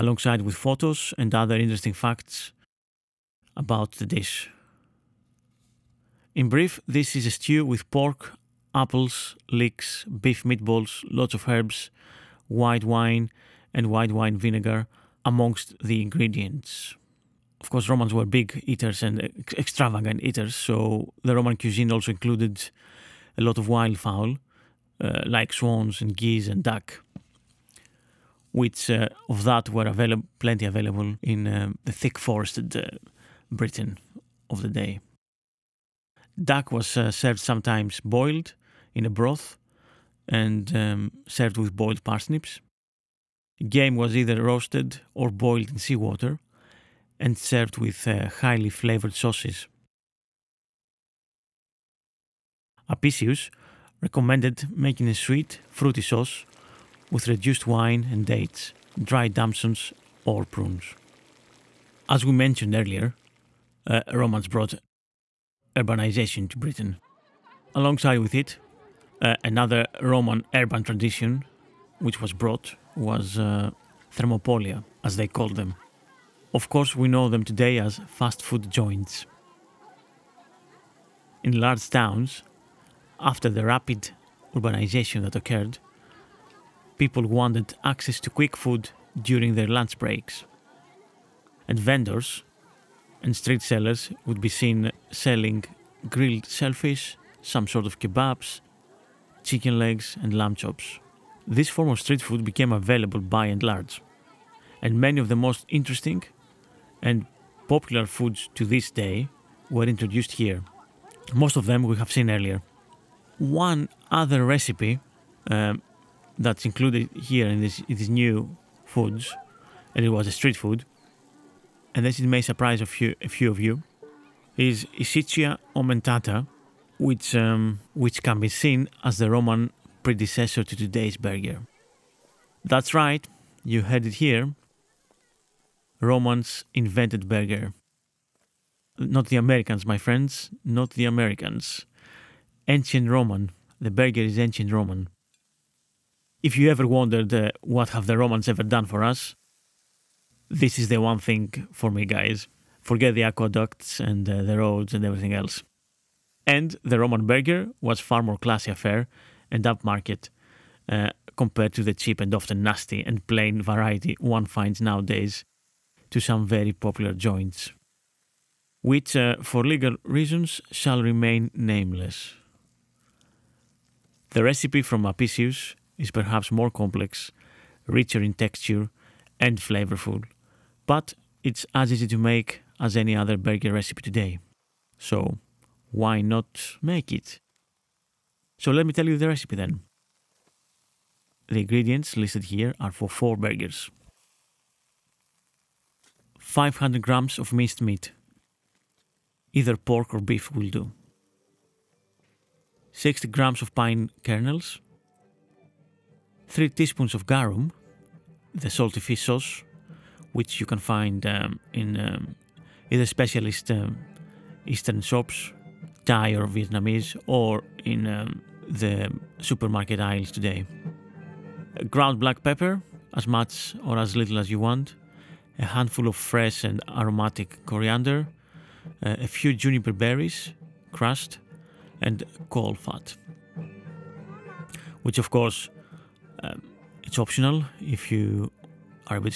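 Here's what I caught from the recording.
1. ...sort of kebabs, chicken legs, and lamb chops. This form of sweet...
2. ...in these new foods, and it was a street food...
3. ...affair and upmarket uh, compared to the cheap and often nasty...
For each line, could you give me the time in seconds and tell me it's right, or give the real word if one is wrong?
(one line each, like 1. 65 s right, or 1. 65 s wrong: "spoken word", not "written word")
1. 97 s wrong: "street", not "sweet"
2. 117 s right
3. 158 s right.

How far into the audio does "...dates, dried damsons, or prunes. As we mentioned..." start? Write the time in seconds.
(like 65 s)
58 s.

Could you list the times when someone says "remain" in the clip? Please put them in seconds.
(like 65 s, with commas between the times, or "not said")
171 s.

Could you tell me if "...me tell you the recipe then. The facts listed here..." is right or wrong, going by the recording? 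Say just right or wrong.
wrong.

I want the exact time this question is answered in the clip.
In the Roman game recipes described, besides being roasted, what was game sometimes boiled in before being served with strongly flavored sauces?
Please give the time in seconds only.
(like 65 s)
45 s.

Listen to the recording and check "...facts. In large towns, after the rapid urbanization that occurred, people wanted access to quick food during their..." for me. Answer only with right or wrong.
wrong.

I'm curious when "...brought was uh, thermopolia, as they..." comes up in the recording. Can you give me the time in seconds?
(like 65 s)
72 s.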